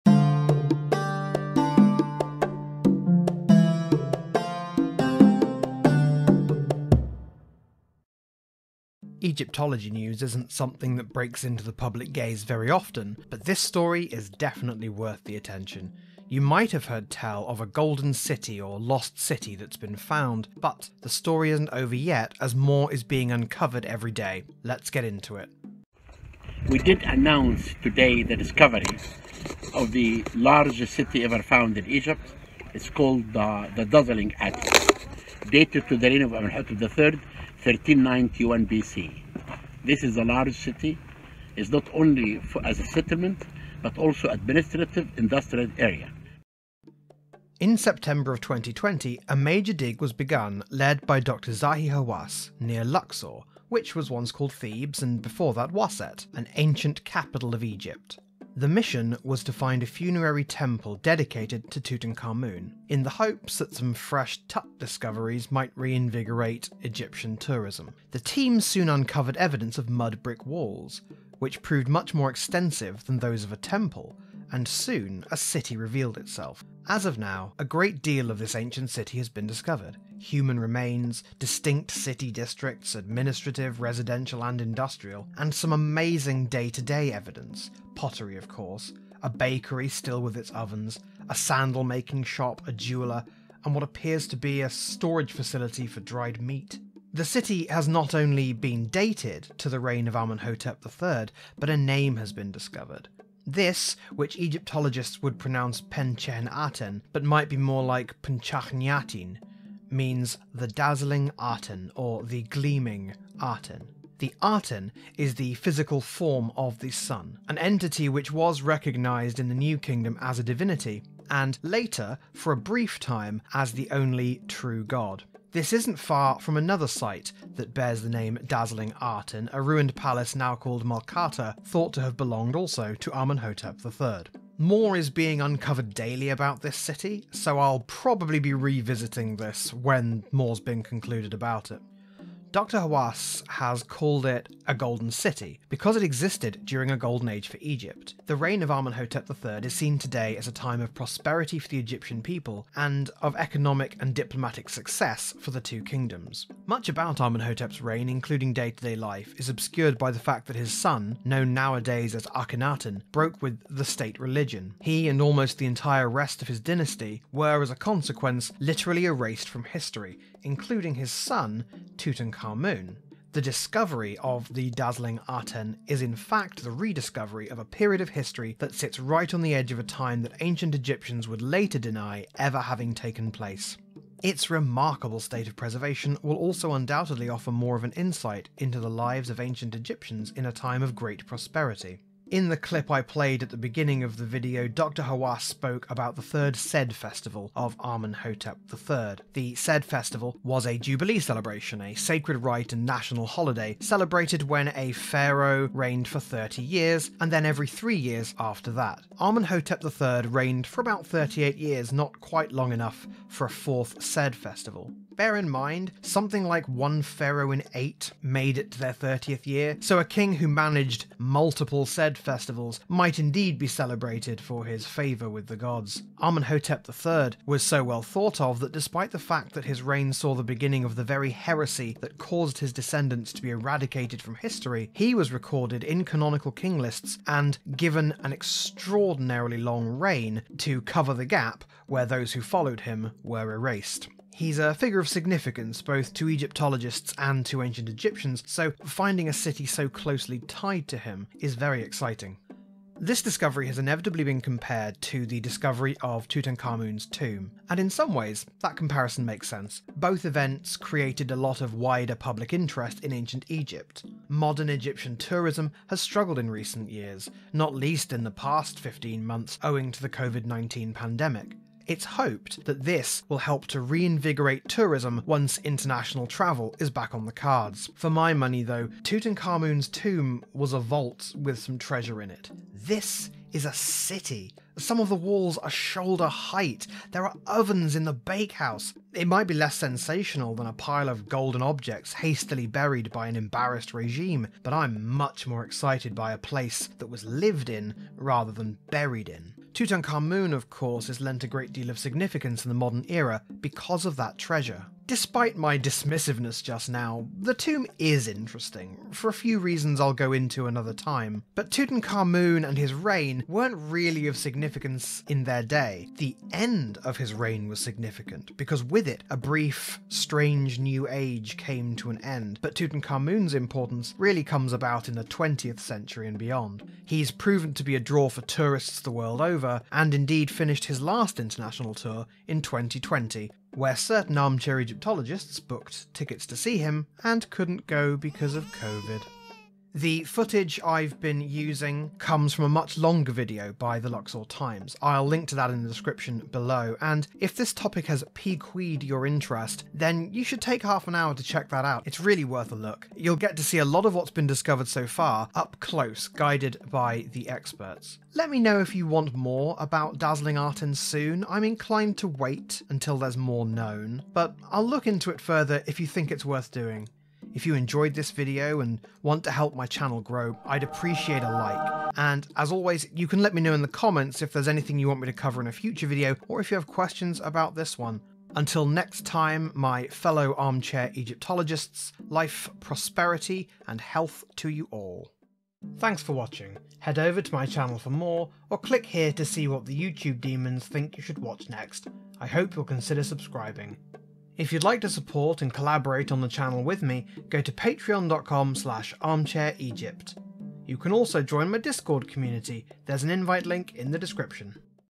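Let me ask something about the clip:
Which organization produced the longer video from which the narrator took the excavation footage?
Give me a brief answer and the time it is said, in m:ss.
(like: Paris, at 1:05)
Luxor Times, at 5:43.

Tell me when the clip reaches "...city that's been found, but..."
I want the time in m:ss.
0:19.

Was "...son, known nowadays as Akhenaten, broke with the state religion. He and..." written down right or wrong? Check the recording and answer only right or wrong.
right.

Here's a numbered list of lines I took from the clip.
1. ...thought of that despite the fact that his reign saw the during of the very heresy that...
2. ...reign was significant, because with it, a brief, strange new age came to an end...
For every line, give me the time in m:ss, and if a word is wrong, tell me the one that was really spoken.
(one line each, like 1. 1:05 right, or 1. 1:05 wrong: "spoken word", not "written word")
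1. 3:48 wrong: "beginning", not "during"
2. 5:17 right.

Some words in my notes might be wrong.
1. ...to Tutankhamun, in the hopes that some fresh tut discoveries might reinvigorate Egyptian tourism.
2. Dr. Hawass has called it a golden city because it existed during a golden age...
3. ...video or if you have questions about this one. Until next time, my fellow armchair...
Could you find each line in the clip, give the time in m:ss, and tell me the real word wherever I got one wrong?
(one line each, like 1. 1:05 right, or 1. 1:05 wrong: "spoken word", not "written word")
1. 1:01 right
2. 2:22 right
3. 6:16 right.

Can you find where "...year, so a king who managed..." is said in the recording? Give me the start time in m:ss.
3:39.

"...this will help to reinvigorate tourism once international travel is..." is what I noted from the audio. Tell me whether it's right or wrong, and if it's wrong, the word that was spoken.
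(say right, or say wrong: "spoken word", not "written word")
right.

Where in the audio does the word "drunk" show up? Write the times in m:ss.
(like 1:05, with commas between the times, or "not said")
not said.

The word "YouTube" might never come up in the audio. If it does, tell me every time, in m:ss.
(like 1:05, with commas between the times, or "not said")
6:29.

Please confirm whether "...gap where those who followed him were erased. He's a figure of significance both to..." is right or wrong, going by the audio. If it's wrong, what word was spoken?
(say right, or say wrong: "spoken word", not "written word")
right.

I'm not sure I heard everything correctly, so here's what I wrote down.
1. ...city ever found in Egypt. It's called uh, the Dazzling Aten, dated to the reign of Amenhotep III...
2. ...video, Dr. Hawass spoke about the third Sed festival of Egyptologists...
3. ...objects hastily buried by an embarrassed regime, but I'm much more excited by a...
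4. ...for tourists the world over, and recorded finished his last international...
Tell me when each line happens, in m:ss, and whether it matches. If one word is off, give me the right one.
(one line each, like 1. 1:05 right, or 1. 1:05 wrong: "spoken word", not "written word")
1. 0:30 right
2. 3:14 wrong: "Amenhotep", not "Egyptologists"
3. 4:51 right
4. 5:28 wrong: "indeed", not "recorded".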